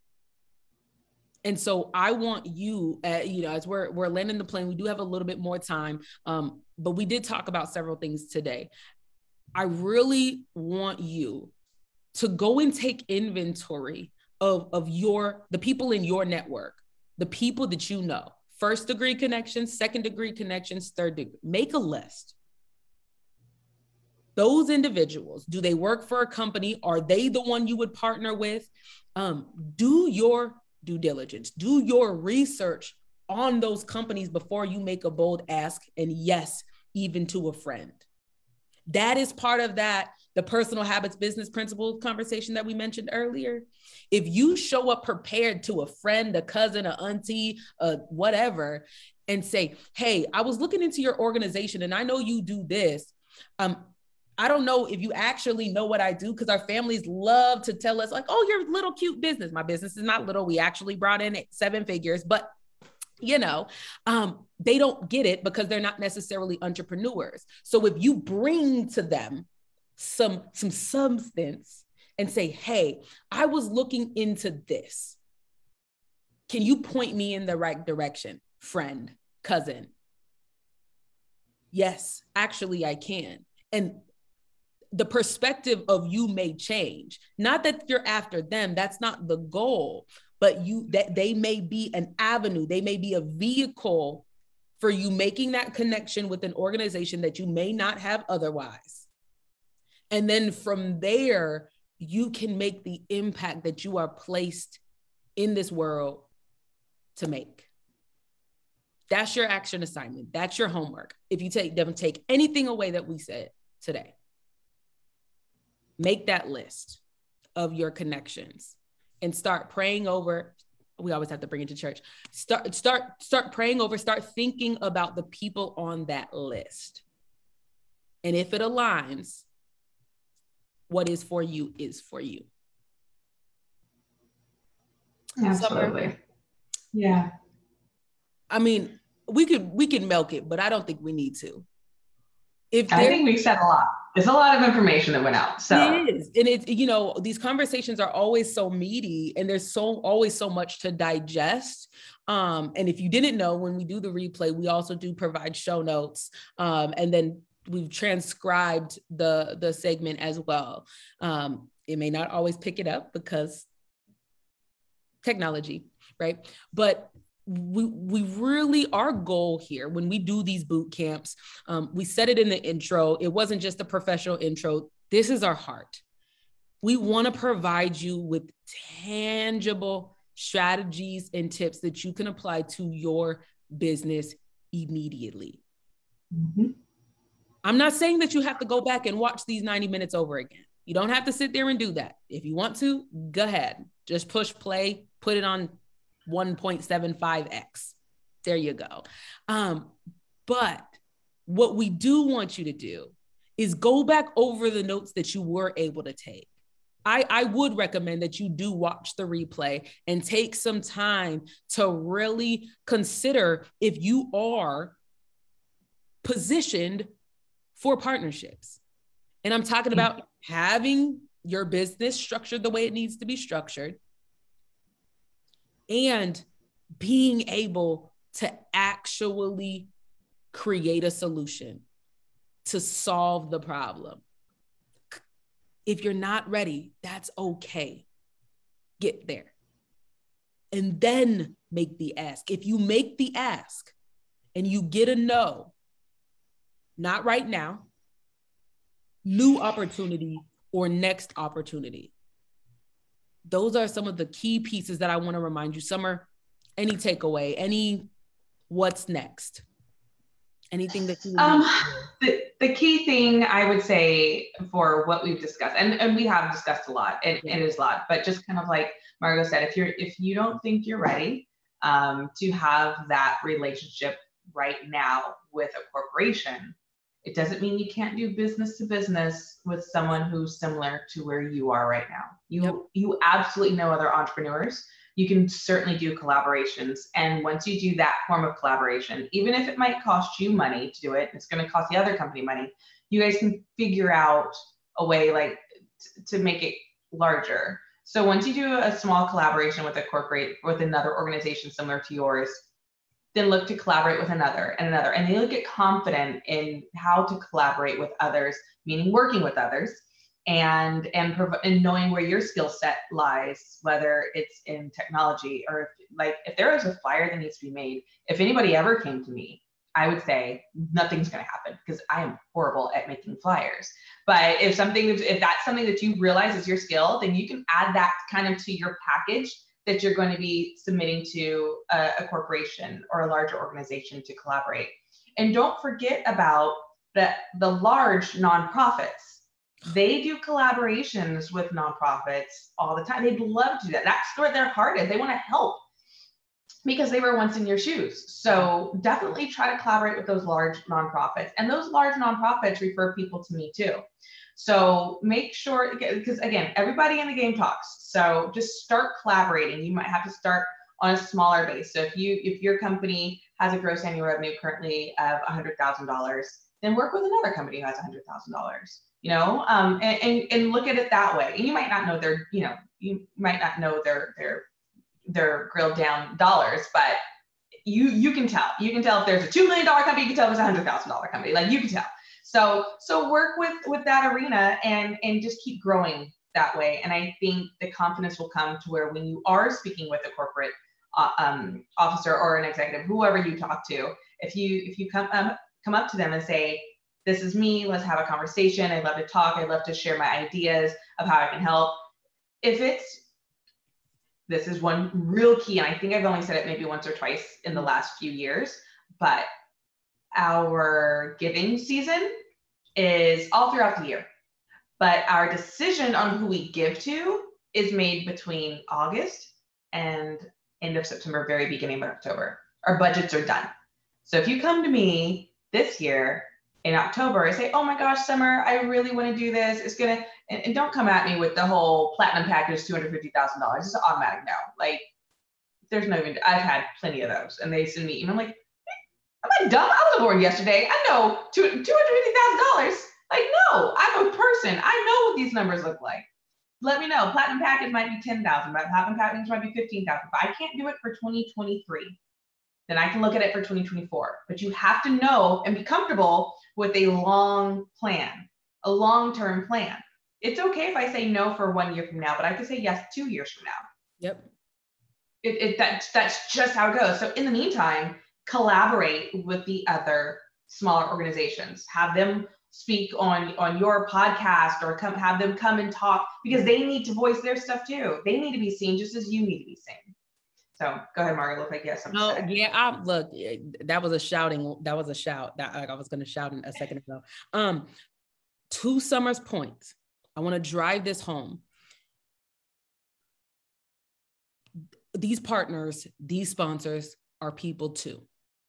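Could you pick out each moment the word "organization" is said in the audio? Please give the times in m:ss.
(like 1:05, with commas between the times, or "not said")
0:51, 1:36, 5:01, 5:33, 7:51.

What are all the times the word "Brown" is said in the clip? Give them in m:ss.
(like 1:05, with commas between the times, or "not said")
not said.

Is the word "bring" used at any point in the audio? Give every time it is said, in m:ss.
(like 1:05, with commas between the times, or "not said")
1:08, 2:01.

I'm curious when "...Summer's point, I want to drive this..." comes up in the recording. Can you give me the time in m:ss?
8:08.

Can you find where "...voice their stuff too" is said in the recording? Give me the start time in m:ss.
7:57.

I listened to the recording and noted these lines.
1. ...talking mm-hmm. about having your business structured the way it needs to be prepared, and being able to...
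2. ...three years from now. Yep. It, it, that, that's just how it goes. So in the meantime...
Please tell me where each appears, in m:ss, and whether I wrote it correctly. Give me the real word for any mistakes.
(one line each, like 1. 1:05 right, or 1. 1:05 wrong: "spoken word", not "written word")
1. 3:39 wrong: "structured", not "prepared"
2. 7:43 wrong: "two", not "three".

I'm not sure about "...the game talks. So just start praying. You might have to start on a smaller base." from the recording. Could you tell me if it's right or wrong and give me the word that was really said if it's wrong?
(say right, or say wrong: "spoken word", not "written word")
wrong: "collaborating", not "praying".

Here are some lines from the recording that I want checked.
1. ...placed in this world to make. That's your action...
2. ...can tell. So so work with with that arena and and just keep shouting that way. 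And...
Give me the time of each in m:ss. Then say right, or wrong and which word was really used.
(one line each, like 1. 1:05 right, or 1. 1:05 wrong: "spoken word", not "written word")
1. 1:44 right
2. 6:21 wrong: "growing", not "shouting".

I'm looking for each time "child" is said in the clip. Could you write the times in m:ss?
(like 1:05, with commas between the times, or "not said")
not said.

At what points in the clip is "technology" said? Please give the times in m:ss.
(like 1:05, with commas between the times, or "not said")
2:45, 5:14.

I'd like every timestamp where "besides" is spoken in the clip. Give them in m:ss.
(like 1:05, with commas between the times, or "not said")
not said.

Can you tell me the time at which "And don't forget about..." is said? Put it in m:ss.
5:35.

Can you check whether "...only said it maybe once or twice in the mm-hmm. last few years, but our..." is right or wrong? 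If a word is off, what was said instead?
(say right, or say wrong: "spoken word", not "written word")
right.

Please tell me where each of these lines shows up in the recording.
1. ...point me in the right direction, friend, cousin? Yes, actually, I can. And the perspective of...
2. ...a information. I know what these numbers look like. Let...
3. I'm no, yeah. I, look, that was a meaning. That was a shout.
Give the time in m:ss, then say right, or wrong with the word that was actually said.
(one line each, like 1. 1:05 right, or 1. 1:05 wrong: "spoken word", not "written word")
1. 1:16 right
2. 7:24 wrong: "person", not "information"
3. 8:02 wrong: "shouting", not "meaning".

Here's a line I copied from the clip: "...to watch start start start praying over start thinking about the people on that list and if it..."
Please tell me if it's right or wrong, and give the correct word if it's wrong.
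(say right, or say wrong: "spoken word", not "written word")
wrong: "church", not "watch".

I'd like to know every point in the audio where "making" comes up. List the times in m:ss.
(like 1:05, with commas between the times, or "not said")
1:35, 5:23.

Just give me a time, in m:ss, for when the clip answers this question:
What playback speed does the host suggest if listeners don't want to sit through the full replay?
3:16.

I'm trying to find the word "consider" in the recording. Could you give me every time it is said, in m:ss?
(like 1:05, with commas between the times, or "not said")
3:32.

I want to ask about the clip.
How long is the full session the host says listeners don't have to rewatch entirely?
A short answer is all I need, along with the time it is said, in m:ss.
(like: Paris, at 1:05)
90 minutes, at 3:09.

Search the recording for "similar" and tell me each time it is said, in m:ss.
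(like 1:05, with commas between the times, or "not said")
4:40, 5:01.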